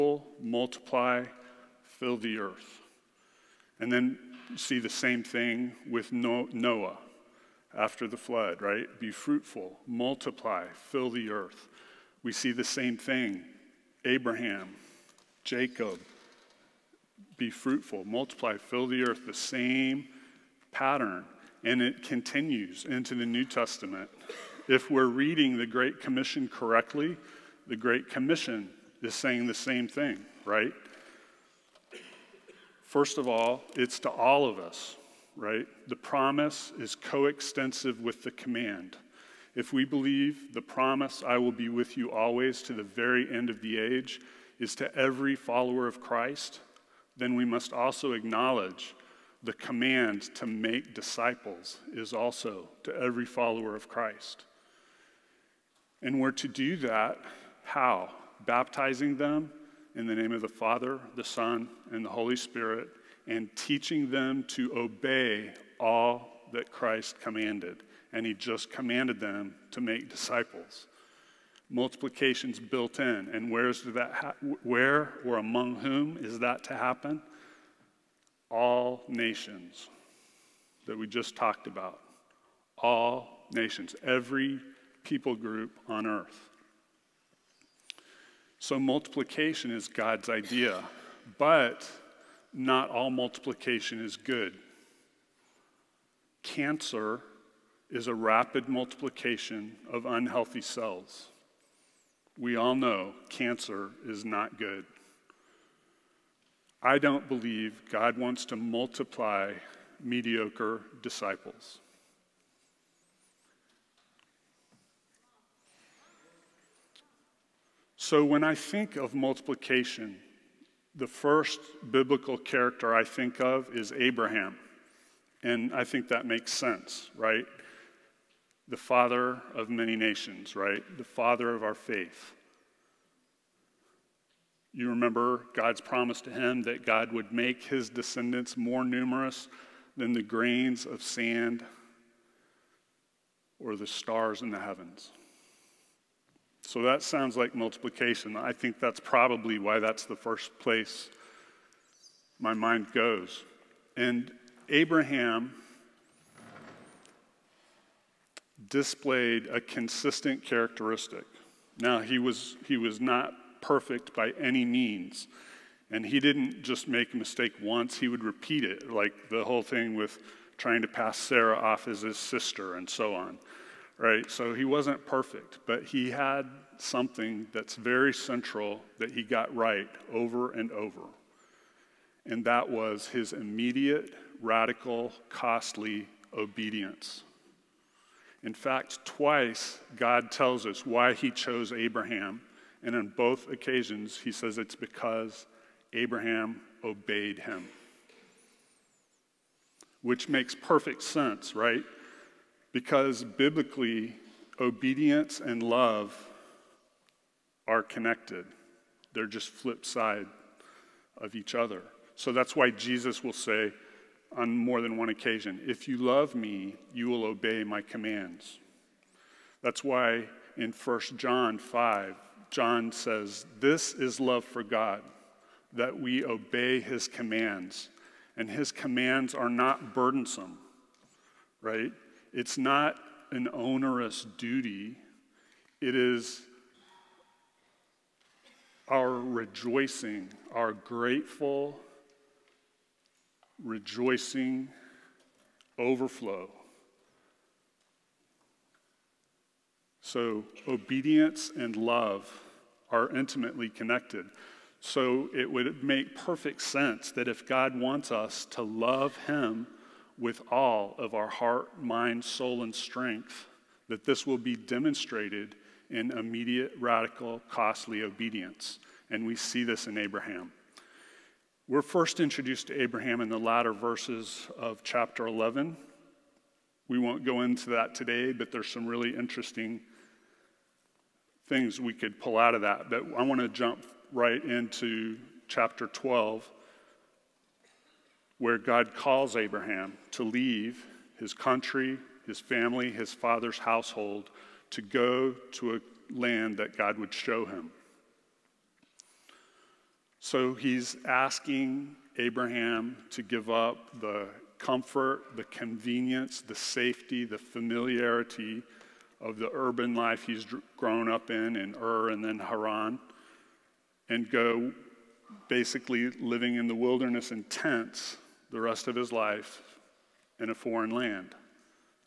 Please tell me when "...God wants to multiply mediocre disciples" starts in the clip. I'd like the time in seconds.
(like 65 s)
107 s.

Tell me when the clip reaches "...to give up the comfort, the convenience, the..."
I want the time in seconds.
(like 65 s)
303 s.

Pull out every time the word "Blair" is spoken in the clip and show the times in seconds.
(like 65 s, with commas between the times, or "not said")
not said.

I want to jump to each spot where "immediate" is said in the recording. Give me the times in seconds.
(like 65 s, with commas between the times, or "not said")
183 s, 266 s.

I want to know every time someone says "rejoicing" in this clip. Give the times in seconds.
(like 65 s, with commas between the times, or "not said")
239 s, 243 s.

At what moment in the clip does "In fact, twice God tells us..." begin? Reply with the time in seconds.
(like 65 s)
188 s.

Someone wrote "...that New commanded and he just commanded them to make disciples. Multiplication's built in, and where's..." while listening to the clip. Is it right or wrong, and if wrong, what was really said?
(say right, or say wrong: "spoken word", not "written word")
wrong: "Christ", not "New".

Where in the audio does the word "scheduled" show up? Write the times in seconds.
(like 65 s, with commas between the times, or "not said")
not said.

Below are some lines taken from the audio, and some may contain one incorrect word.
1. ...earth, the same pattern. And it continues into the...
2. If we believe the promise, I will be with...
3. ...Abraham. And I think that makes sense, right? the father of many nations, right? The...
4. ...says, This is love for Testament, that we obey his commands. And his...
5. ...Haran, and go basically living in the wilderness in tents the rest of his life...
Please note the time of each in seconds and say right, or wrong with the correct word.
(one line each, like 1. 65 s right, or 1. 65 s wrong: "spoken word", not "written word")
1. 19 s right
2. 39 s right
3. 123 s right
4. 222 s wrong: "God", not "Testament"
5. 312 s right.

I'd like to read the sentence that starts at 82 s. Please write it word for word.
All nations, every people group on earth.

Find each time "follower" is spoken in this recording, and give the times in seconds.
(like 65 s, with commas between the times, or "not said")
45 s, 53 s.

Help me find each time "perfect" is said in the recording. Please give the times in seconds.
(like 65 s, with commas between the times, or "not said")
163 s, 175 s, 200 s, 256 s.